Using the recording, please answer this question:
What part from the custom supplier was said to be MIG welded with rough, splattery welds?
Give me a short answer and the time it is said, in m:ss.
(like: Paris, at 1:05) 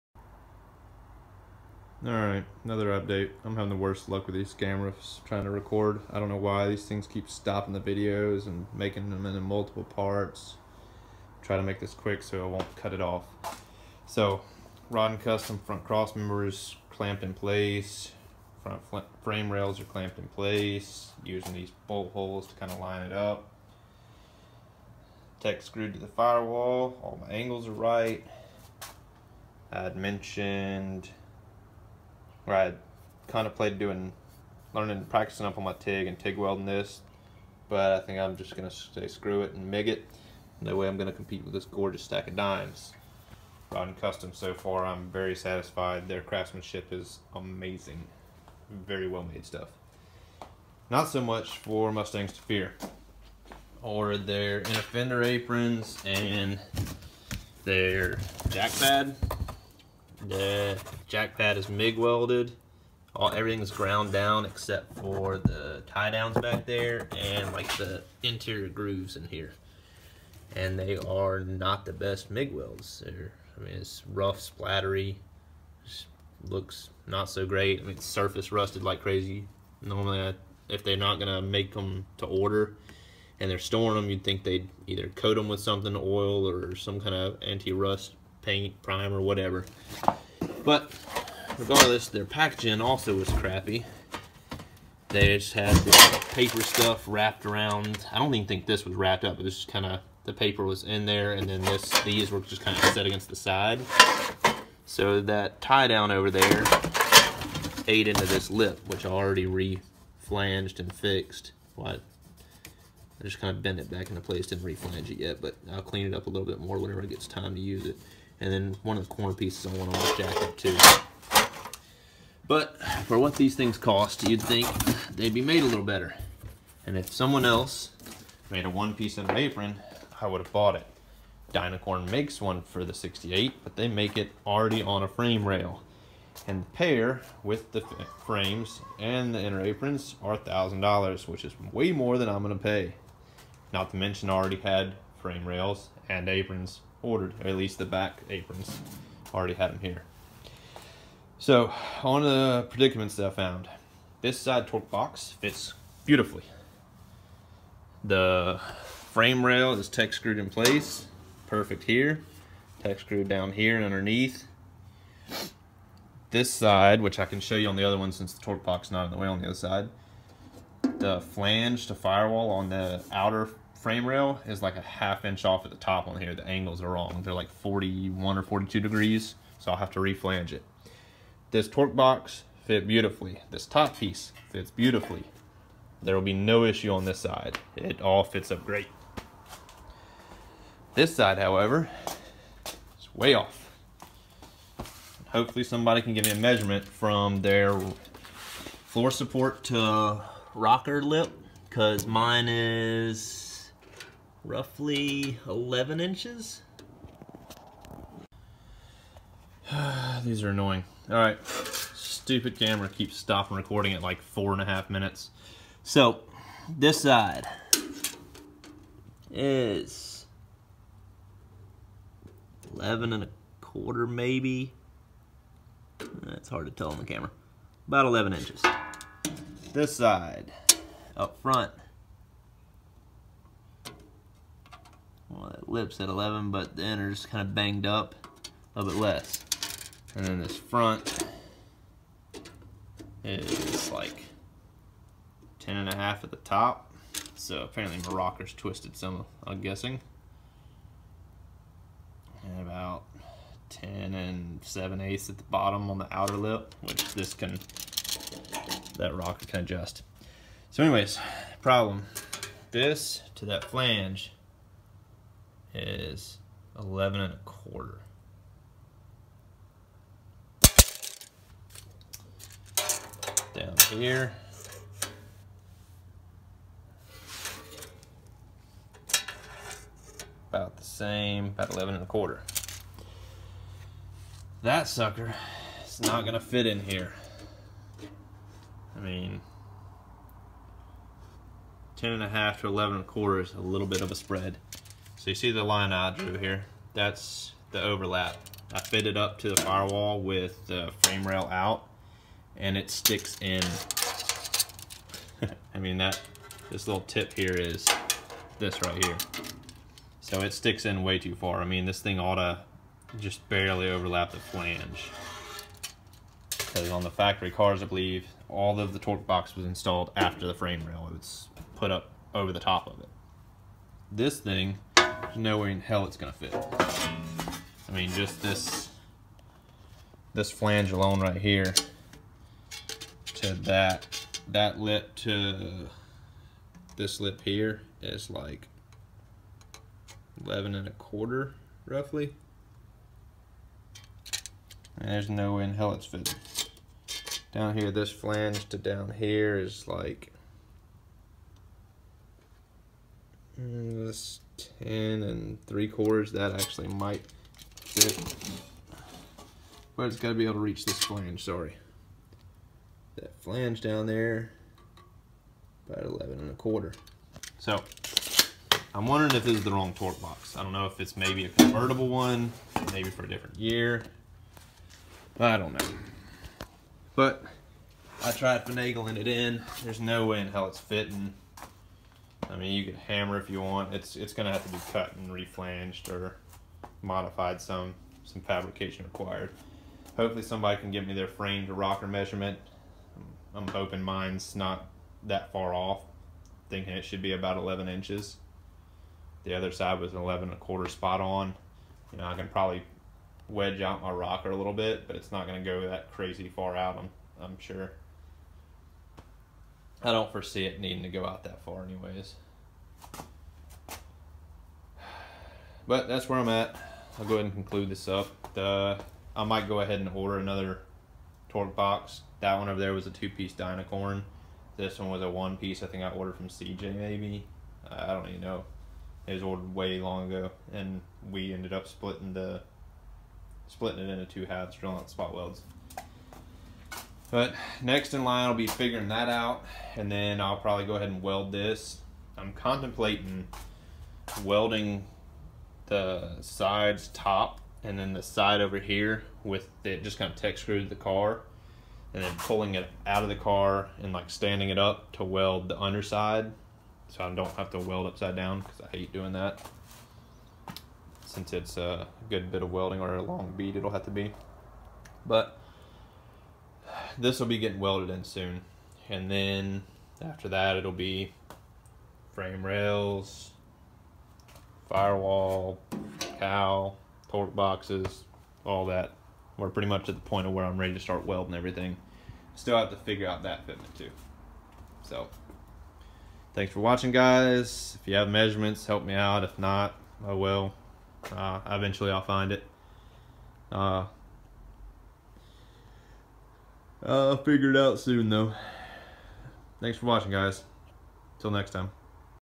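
The jack pad, at 1:00.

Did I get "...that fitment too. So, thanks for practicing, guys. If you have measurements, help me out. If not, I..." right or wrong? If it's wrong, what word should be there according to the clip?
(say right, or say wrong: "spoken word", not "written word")
wrong: "watching", not "practicing".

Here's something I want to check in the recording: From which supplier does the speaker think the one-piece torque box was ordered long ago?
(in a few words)
CJ.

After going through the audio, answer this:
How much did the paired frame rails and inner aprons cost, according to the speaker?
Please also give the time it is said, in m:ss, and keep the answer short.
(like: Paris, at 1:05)
$1,000, at 2:20.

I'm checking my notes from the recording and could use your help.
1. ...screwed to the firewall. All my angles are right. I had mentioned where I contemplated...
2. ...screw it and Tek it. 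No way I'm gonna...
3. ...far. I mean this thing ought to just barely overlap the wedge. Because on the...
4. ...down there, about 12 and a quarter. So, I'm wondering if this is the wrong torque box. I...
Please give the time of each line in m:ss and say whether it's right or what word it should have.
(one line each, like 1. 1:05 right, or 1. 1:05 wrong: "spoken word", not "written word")
1. 0:25 right
2. 0:39 wrong: "MIG", not "Tek"
3. 5:11 wrong: "flange", not "wedge"
4. 6:03 wrong: "11", not "12".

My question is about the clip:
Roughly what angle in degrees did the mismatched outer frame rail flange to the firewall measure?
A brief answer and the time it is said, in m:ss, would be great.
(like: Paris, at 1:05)
41 or 42 degrees, at 2:57.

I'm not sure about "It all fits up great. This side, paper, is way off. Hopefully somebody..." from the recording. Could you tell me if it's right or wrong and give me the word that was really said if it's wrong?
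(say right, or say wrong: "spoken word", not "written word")
wrong: "however", not "paper".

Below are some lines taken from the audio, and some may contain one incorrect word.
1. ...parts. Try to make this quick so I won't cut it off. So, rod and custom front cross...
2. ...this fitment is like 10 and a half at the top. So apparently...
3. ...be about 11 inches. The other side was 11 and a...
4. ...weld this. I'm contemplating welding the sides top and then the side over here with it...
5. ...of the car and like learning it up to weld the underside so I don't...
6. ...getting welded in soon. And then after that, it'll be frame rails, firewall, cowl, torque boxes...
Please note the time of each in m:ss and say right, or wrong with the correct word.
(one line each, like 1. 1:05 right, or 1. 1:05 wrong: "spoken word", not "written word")
1. 0:09 right
2. 4:00 wrong: "front", not "fitment"
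3. 6:37 right
4. 7:21 right
5. 7:33 wrong: "standing", not "learning"
6. 7:47 right.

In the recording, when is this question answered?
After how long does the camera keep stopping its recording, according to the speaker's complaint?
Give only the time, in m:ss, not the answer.
3:34.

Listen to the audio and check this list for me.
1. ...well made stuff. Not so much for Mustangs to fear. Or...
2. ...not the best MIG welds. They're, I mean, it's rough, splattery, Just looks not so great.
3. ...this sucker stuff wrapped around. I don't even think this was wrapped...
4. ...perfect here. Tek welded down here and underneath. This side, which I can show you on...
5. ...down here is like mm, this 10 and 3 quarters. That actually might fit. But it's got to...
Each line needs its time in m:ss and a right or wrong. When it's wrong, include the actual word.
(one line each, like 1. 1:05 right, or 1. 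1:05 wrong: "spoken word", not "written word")
1. 0:49 right
2. 1:11 right
3. 1:35 wrong: "paper", not "sucker"
4. 2:41 wrong: "screwed", not "welded"
5. 5:48 right.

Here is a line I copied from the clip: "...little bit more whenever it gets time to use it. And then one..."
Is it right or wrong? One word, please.
right.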